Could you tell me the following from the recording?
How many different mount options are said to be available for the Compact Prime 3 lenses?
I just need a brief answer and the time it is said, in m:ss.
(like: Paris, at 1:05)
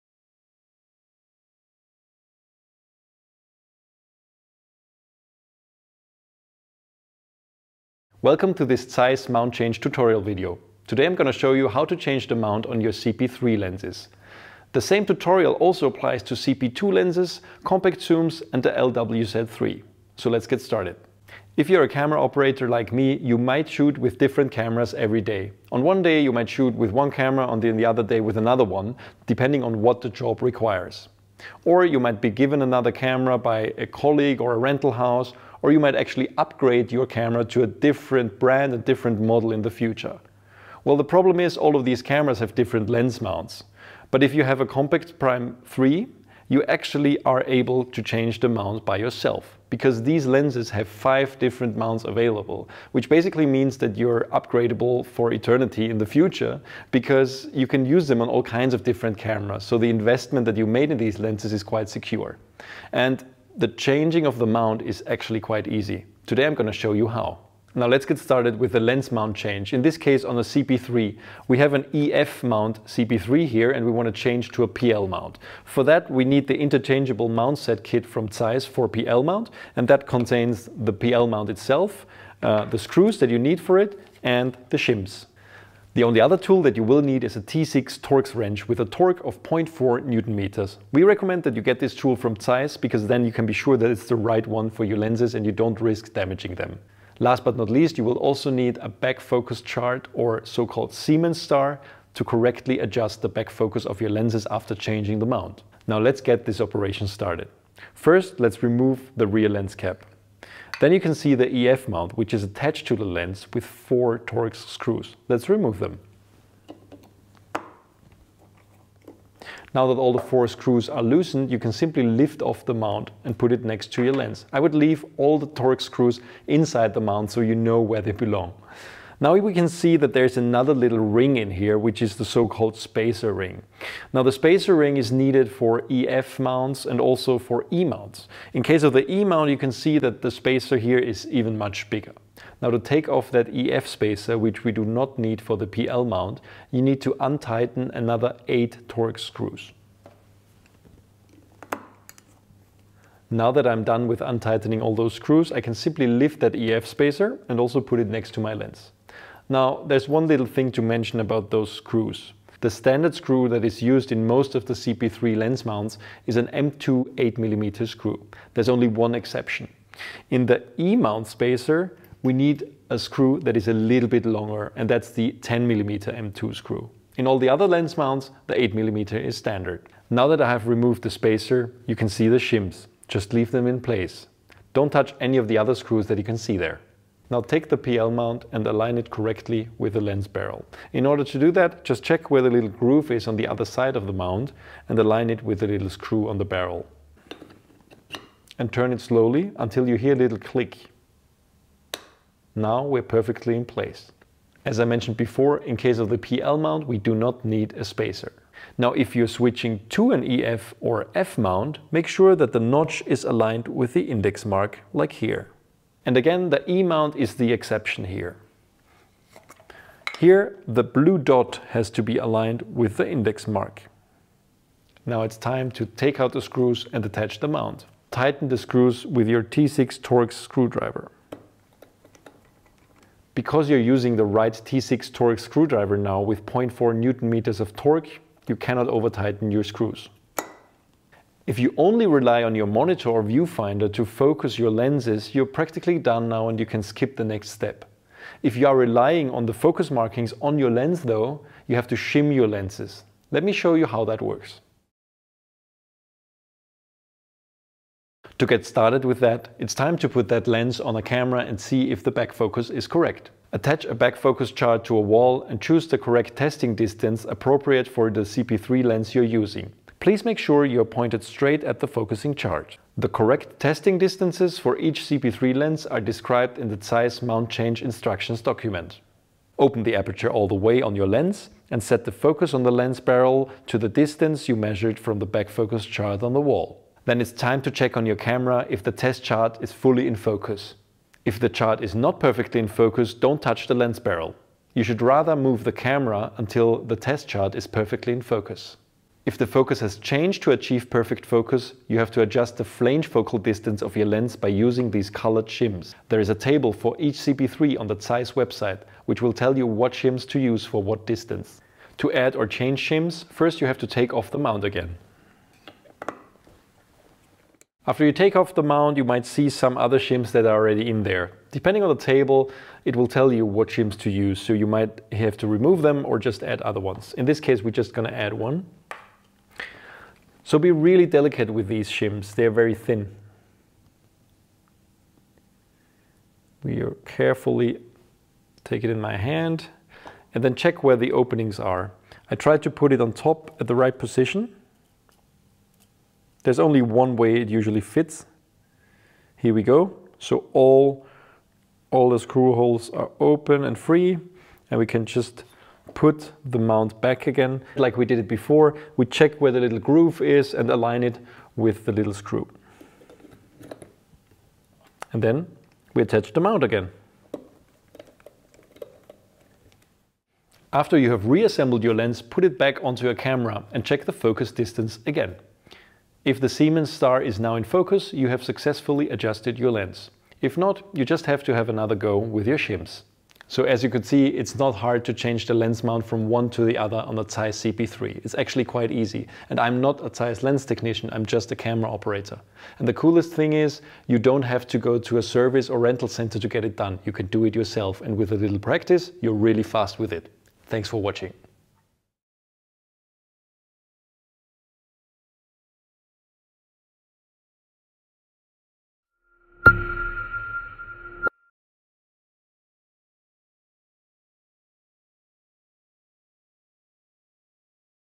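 5, at 0:50.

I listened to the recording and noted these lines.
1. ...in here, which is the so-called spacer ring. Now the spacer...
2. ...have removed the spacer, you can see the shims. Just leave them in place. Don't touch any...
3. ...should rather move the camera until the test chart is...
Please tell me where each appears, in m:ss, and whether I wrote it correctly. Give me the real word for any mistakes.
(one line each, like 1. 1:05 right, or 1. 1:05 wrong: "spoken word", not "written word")
1. 2:11 right
2. 3:00 right
3. 4:54 right.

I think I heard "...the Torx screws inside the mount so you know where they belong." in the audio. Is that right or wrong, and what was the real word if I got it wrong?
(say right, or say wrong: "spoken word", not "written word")
right.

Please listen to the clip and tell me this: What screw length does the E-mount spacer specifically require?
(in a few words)
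10mm.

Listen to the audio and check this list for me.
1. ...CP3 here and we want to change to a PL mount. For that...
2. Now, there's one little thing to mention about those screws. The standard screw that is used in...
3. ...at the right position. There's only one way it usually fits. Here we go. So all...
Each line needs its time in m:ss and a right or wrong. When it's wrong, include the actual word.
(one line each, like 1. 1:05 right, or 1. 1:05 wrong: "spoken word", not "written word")
1. 1:12 right
2. 2:39 right
3. 5:43 right.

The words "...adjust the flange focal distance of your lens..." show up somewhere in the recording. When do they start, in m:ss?
5:02.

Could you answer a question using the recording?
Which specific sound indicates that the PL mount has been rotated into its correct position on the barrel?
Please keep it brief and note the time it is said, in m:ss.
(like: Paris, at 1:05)
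a little click, at 3:20.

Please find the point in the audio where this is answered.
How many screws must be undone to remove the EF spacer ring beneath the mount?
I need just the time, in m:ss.
2:28.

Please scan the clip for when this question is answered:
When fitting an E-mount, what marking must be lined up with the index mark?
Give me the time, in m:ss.
3:40.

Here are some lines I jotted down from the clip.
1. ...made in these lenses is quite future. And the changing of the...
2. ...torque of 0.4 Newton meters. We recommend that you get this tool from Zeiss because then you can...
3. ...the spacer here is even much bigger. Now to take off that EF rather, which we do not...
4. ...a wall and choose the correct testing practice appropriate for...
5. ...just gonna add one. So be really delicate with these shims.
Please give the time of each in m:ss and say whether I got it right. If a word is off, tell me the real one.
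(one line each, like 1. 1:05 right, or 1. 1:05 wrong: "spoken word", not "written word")
1. 1:00 wrong: "secure", not "future"
2. 1:28 right
3. 2:20 wrong: "spacer", not "rather"
4. 4:24 wrong: "distance", not "practice"
5. 5:27 right.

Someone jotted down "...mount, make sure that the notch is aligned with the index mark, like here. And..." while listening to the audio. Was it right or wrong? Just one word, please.
right.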